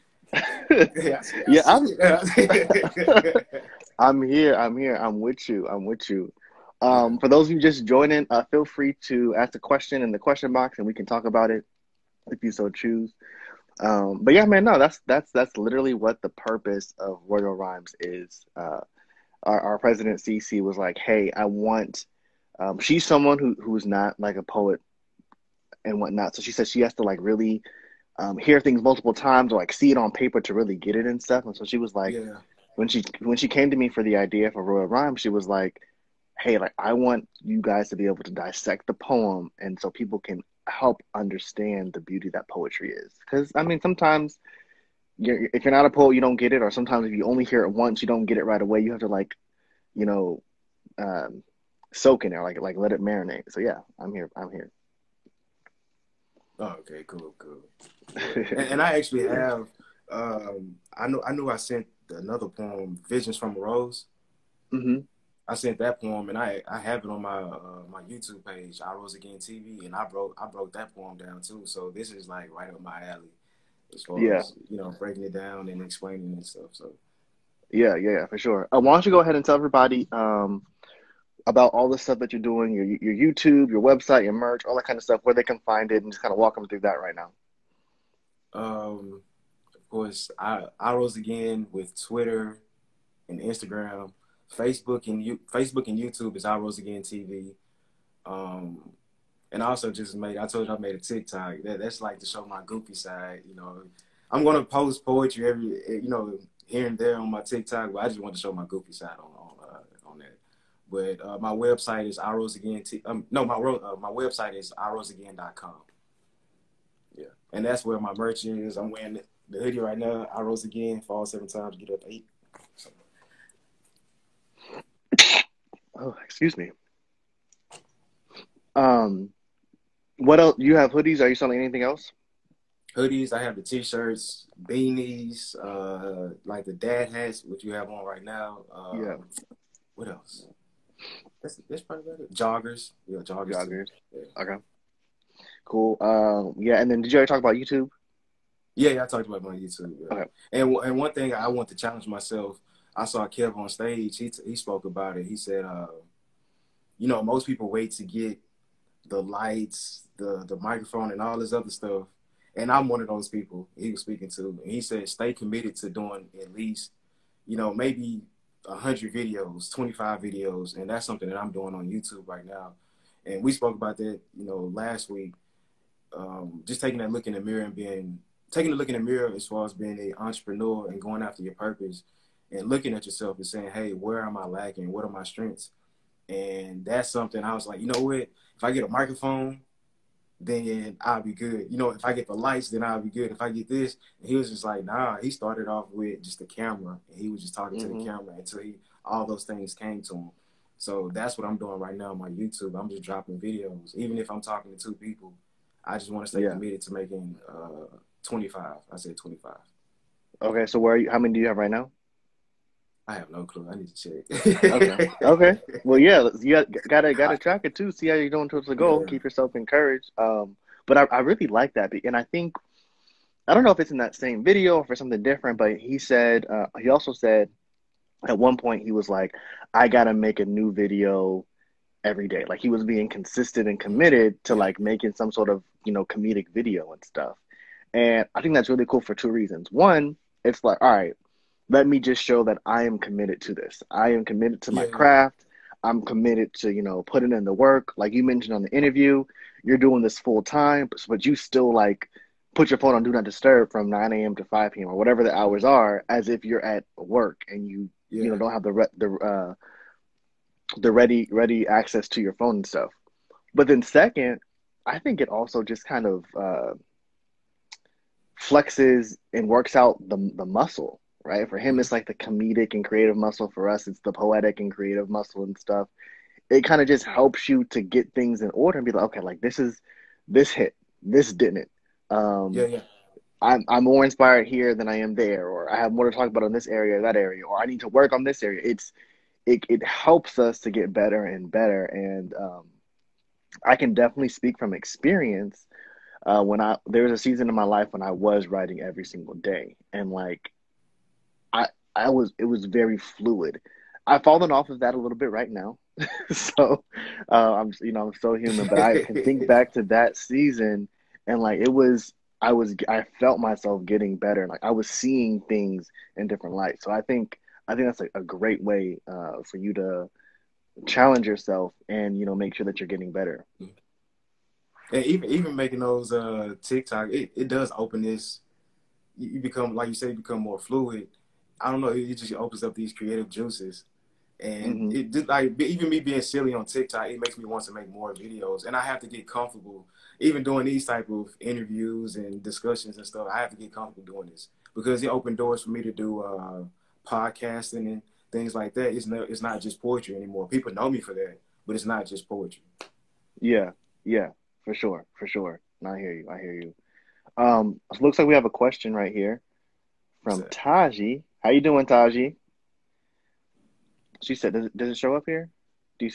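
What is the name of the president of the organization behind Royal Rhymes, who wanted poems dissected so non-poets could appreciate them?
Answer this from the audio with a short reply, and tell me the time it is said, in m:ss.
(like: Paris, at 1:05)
CC, at 0:20.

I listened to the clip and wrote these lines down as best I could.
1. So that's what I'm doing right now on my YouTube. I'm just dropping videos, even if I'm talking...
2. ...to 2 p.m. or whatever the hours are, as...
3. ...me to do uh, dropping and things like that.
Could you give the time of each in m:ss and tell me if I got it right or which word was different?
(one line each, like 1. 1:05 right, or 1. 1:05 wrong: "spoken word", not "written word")
1. 3:20 right
2. 4:14 wrong: "5", not "2"
3. 5:45 wrong: "podcasting", not "dropping".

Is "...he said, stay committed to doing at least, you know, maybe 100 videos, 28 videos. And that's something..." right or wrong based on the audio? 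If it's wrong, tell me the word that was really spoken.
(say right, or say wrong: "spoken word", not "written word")
wrong: "25", not "28".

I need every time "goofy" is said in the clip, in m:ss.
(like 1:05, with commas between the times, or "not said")
1:42, 1:48.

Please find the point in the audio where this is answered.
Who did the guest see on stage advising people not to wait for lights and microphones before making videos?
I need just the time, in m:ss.
2:33.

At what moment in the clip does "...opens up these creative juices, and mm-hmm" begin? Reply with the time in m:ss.
5:32.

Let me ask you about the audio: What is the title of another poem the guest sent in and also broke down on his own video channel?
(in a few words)
Visions from a Rose.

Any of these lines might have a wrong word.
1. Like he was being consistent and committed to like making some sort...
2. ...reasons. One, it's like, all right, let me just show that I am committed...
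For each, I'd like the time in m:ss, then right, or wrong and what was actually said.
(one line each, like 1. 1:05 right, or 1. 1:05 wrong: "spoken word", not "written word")
1. 3:52 right
2. 3:59 right.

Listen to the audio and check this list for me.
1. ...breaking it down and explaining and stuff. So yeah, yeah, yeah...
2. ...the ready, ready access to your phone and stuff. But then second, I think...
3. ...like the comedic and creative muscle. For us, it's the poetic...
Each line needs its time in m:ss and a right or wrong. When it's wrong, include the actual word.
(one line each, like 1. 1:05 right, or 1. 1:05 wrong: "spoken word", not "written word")
1. 1:14 right
2. 4:20 right
3. 4:31 right.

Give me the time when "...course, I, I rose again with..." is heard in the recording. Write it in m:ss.
1:29.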